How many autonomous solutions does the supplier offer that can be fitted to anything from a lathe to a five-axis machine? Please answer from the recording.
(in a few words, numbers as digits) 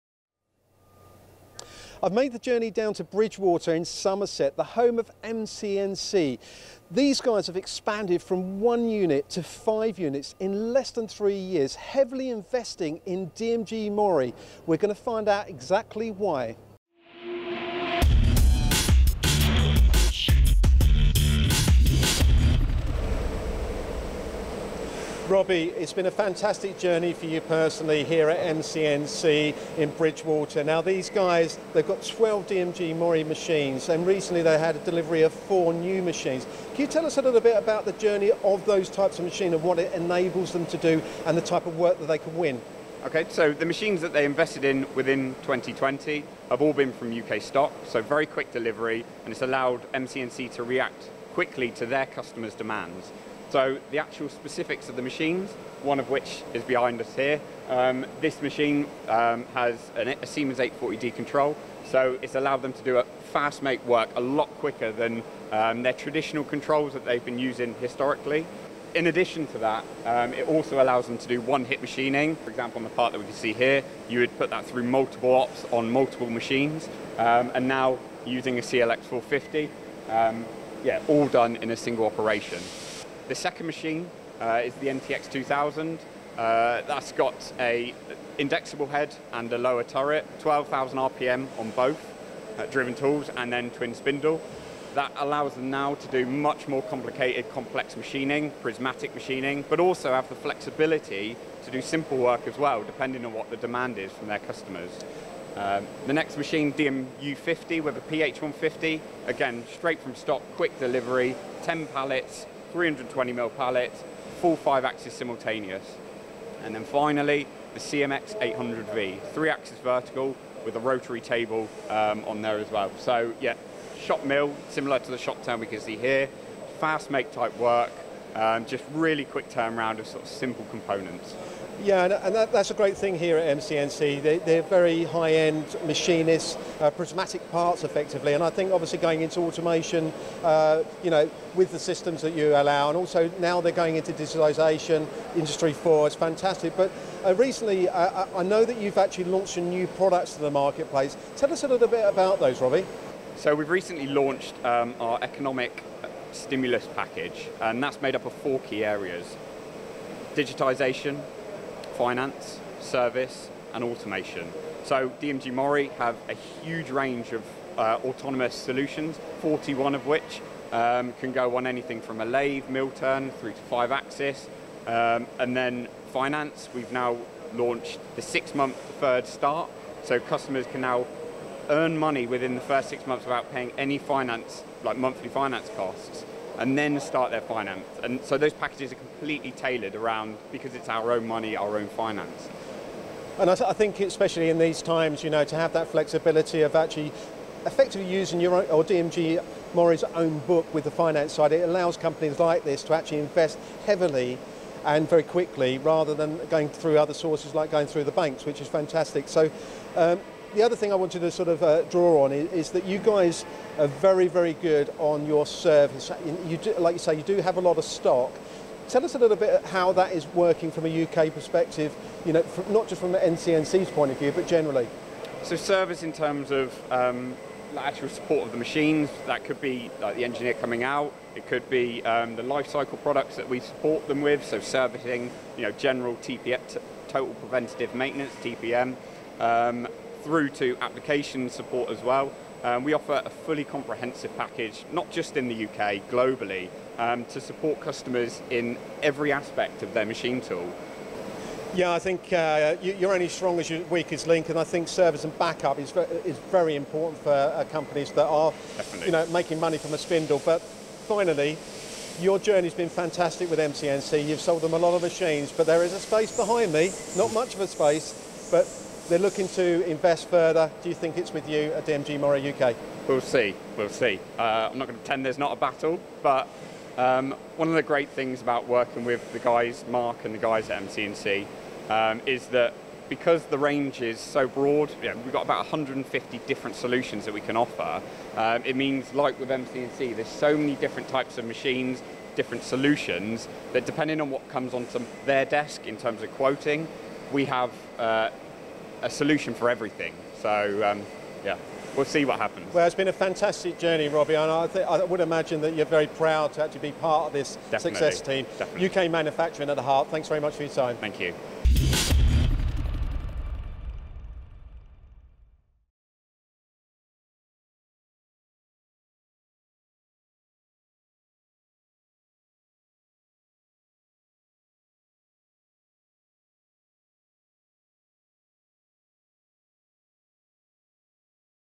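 41.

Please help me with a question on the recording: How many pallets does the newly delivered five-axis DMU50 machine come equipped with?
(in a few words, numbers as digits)
10.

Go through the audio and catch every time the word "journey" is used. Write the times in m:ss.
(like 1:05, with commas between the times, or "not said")
0:02, 0:26, 0:37, 4:22, 5:03.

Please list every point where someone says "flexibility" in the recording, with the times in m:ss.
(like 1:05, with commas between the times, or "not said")
1:40, 3:15.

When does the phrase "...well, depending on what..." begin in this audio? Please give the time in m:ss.
1:42.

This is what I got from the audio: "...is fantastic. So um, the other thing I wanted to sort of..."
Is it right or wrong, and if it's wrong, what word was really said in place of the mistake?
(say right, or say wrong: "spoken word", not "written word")
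right.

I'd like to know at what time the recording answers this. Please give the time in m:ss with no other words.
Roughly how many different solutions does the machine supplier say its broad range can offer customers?
4:45.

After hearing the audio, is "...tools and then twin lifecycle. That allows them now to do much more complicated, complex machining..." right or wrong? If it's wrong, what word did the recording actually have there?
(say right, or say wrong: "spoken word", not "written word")
wrong: "spindle", not "lifecycle".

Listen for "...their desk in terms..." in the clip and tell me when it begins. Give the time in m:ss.
4:55.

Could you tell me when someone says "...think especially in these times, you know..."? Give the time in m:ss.
3:13.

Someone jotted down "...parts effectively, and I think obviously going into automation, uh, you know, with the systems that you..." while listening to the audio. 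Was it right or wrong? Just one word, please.
right.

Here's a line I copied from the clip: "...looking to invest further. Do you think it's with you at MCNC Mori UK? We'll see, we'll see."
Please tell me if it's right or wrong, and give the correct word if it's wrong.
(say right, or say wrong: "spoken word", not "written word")
wrong: "DMG", not "MCNC".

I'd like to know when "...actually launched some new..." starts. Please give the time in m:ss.
2:28.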